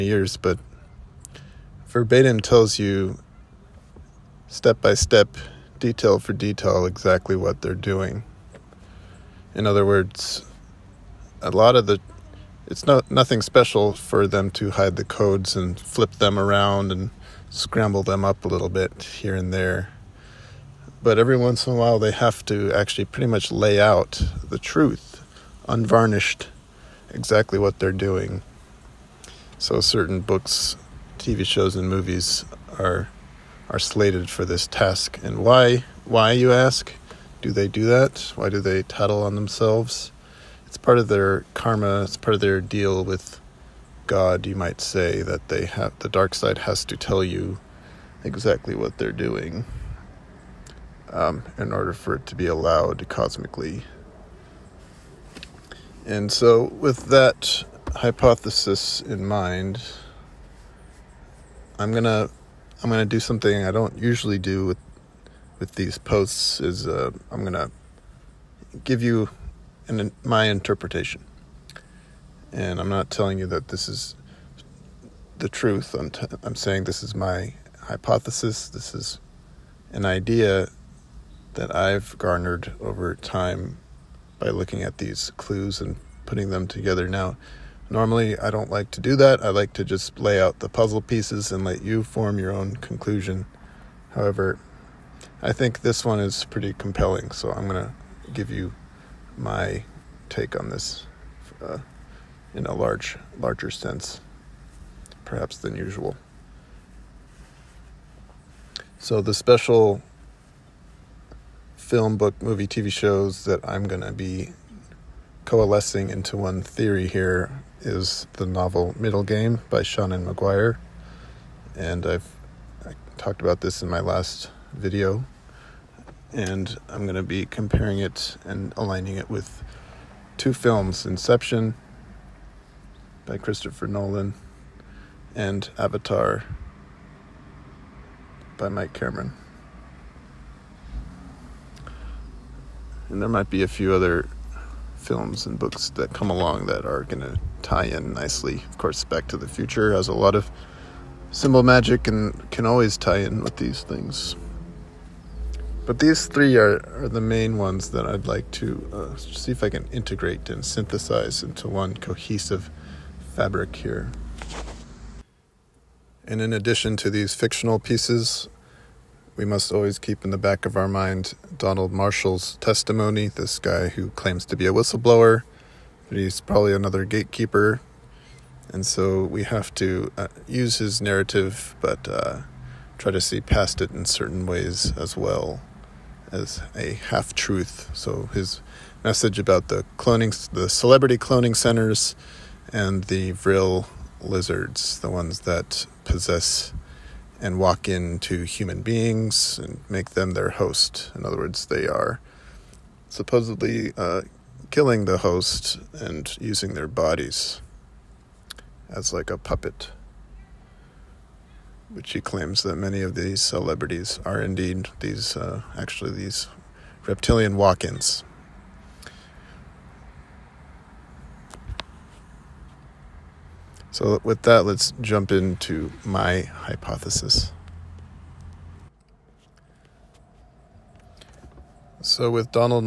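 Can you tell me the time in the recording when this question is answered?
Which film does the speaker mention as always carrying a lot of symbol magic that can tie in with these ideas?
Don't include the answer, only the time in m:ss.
2:29.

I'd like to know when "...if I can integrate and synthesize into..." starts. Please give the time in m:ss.
2:39.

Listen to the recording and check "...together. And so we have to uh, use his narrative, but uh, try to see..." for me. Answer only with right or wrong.
wrong.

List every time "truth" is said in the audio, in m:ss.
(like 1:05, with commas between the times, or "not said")
0:24, 1:15, 3:07.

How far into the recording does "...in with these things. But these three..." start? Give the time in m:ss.
2:33.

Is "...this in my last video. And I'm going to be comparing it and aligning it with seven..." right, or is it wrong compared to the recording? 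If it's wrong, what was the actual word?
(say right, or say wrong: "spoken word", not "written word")
wrong: "two", not "seven".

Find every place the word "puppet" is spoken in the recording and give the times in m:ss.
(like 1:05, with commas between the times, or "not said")
3:29.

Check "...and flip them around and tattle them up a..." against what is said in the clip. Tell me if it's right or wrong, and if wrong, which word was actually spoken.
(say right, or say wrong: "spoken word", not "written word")
wrong: "scramble", not "tattle".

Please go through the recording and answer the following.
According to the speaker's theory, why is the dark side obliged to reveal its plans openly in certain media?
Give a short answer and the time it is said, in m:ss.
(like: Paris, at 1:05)
Karma, at 0:41.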